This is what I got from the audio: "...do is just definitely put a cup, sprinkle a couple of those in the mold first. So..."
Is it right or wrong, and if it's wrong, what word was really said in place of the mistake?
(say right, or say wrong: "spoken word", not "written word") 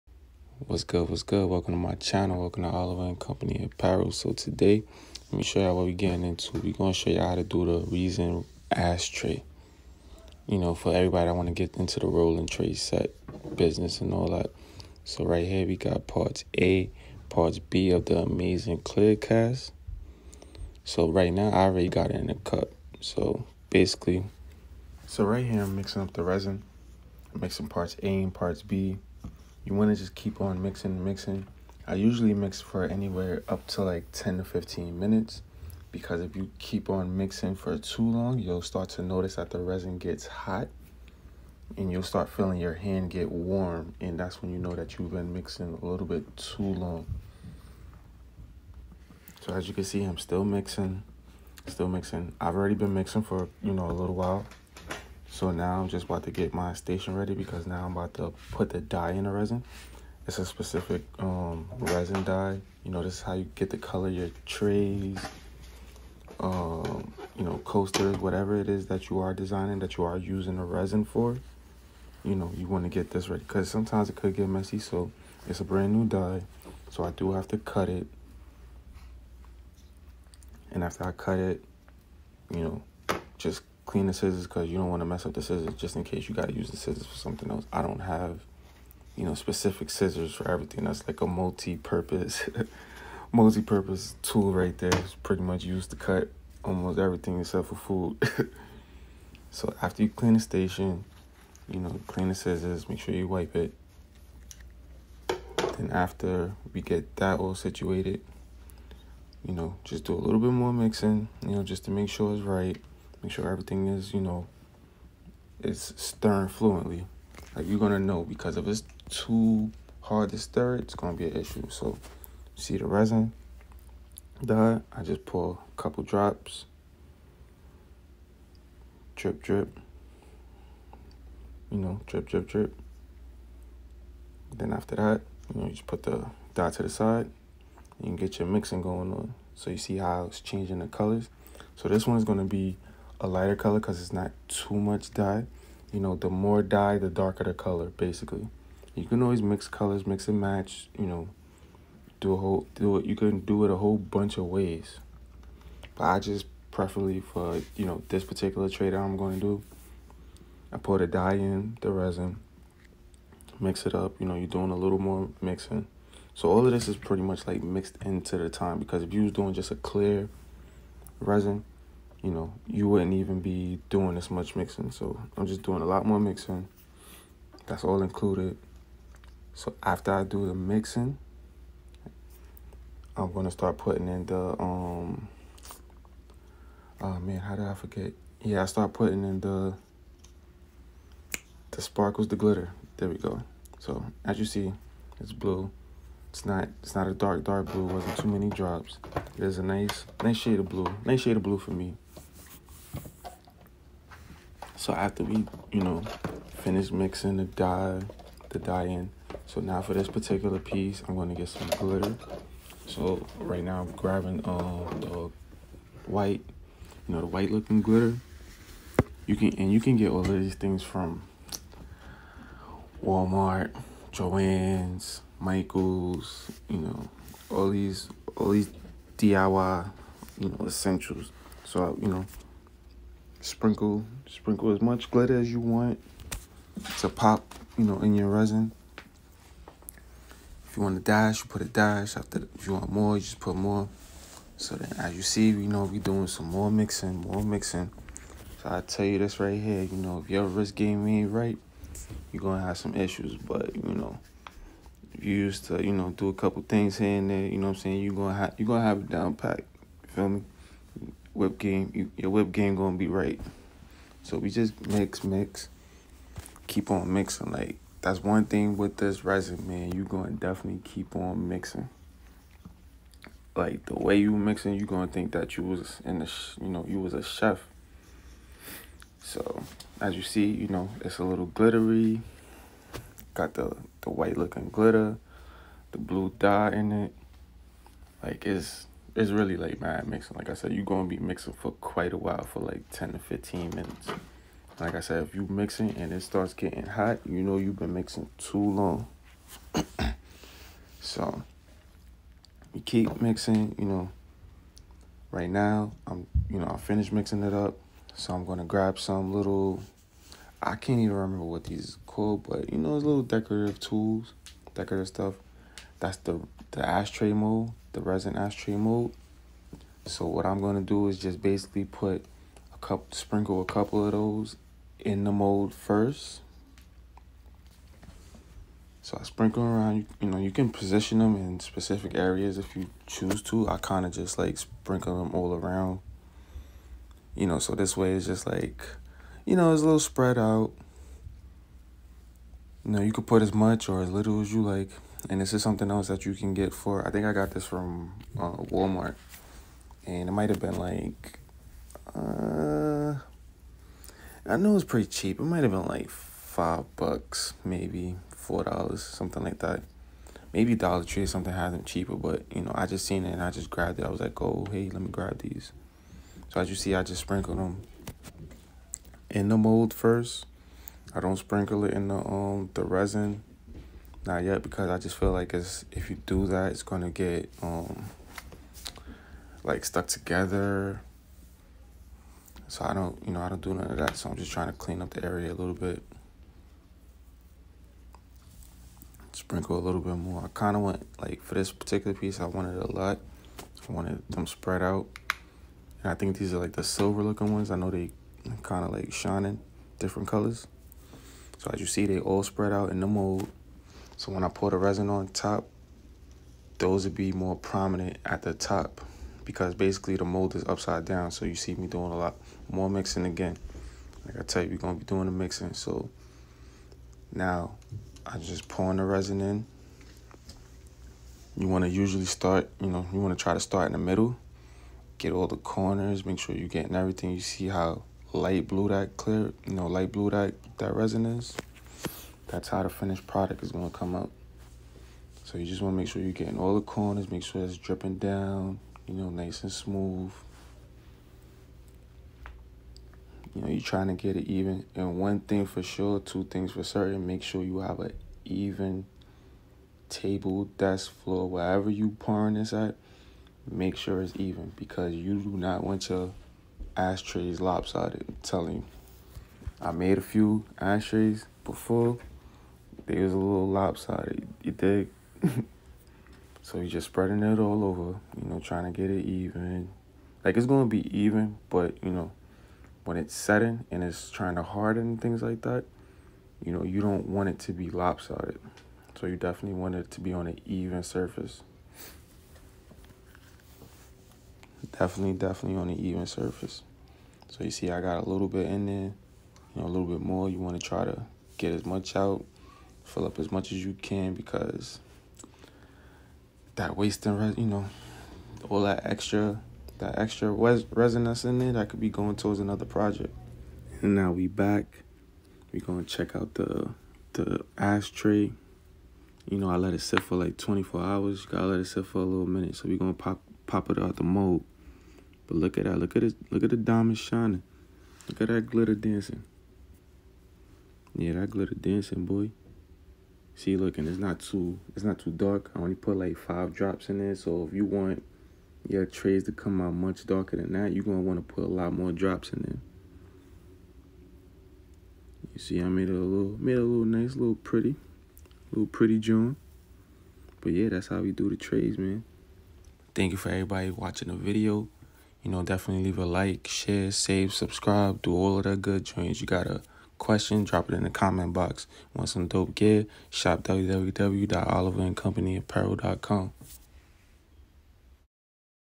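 wrong: "basically", not "definitely".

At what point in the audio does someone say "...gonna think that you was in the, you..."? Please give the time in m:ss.
4:34.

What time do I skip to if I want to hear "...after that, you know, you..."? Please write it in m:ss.
2:14.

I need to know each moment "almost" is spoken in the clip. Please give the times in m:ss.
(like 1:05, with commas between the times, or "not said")
1:36.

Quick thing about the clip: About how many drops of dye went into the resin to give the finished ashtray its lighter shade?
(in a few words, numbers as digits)
5.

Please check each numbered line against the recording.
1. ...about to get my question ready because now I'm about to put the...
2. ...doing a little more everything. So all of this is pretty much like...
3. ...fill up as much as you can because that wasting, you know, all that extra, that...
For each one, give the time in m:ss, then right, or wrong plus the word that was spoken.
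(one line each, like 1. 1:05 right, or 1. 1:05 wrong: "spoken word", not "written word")
1. 0:56 wrong: "station", not "question"
2. 2:44 wrong: "mixing", not "everything"
3. 8:13 right.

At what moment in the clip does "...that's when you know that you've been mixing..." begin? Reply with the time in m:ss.
0:44.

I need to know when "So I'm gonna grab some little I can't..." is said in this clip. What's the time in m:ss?
5:08.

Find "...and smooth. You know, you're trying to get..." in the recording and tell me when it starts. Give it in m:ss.
7:19.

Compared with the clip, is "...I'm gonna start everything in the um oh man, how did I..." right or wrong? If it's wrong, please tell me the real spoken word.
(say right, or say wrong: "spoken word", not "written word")
wrong: "putting", not "everything".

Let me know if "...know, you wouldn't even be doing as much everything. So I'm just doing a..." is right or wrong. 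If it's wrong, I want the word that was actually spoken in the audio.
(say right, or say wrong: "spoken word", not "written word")
wrong: "mixing", not "everything".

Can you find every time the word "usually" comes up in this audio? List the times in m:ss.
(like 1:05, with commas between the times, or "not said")
0:31, 7:01.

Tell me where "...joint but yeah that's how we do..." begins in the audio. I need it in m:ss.
8:59.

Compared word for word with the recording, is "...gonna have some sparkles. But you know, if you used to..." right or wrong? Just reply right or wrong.
wrong.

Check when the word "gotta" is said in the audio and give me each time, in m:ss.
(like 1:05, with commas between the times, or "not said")
8:31, 9:09.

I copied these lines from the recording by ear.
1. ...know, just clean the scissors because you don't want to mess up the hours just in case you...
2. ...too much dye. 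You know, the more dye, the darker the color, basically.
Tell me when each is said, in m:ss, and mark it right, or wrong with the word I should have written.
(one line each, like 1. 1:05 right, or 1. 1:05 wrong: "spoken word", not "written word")
1. 1:22 wrong: "scissors", not "hours"
2. 2:24 right.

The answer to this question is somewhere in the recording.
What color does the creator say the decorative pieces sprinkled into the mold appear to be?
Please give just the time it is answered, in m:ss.
6:36.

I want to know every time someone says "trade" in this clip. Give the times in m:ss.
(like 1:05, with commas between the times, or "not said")
2:38, 9:01.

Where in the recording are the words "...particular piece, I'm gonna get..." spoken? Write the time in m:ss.
3:30.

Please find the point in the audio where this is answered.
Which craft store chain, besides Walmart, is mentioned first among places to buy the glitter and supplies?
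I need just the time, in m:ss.
3:44.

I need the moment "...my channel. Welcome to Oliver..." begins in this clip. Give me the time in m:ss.
0:01.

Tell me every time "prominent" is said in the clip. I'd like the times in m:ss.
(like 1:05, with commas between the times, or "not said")
6:47.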